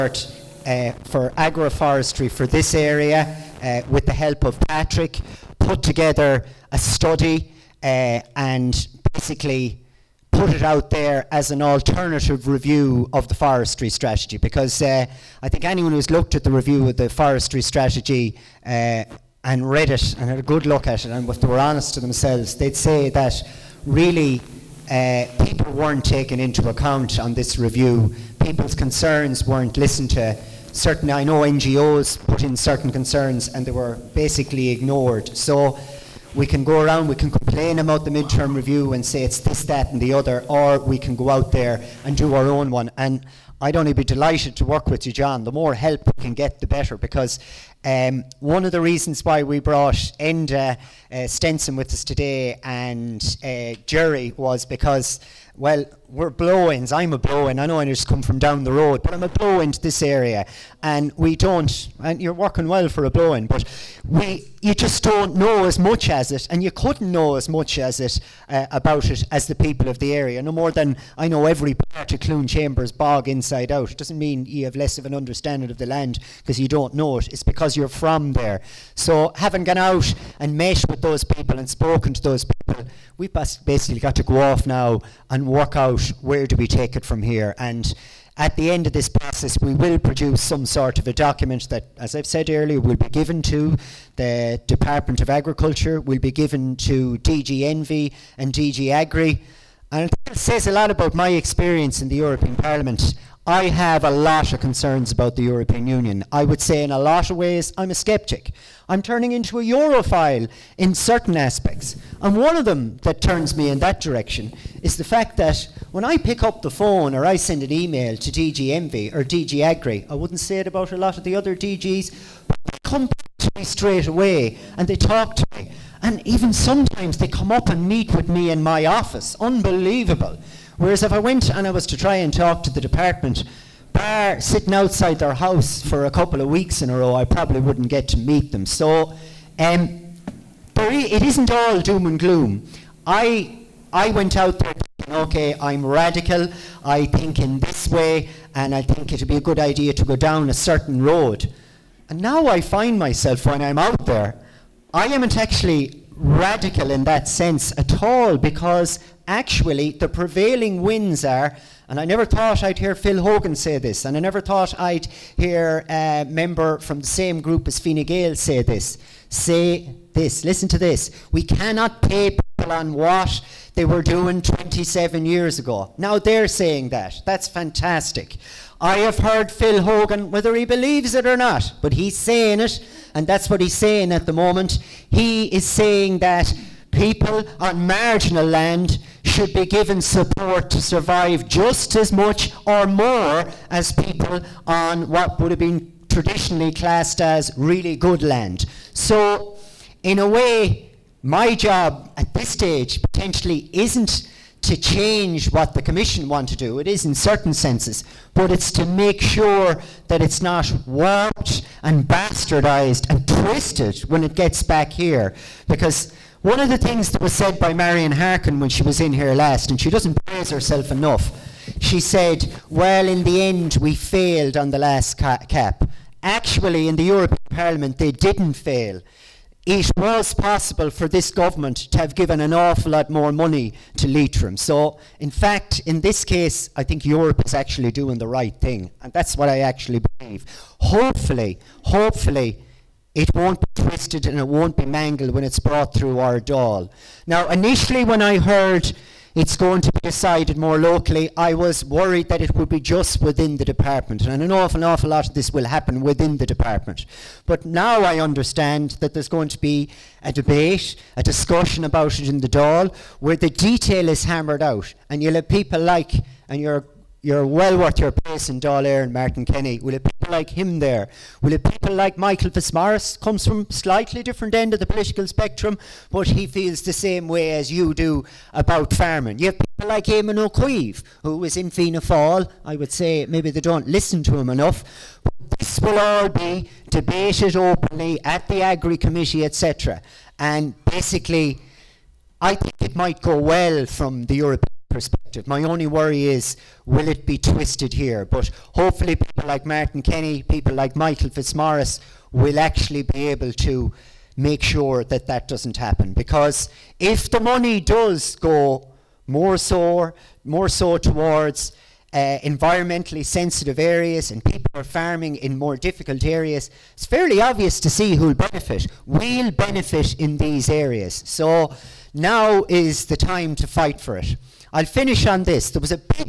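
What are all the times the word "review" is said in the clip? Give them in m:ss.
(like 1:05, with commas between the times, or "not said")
0:12, 0:16, 0:27, 0:38.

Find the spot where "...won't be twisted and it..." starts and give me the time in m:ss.
4:03.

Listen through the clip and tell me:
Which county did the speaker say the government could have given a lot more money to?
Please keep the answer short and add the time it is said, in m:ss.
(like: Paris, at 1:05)
Leitrim, at 3:54.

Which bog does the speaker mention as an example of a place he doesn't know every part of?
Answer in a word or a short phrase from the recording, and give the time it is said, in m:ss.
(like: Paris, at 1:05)
Cloonchambers bog, at 1:12.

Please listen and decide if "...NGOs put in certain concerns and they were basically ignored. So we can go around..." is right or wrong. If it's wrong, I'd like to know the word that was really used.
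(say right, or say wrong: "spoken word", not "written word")
right.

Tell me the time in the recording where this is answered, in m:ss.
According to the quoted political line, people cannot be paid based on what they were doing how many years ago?
2:54.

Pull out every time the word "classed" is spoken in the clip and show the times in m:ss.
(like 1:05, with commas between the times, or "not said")
3:16.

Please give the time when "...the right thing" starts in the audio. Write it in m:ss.
3:58.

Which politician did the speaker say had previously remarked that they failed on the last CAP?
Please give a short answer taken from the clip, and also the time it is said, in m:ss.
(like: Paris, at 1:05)
Marian Harkin, at 3:37.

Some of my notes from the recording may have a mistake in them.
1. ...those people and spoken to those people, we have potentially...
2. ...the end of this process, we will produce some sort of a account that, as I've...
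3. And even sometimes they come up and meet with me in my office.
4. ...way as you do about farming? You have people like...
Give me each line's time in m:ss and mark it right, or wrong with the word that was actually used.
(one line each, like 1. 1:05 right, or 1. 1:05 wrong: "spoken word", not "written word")
1. 1:21 wrong: "basically", not "potentially"
2. 1:28 wrong: "document", not "account"
3. 2:06 right
4. 4:37 right.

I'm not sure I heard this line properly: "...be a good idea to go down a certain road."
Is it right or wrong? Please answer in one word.
right.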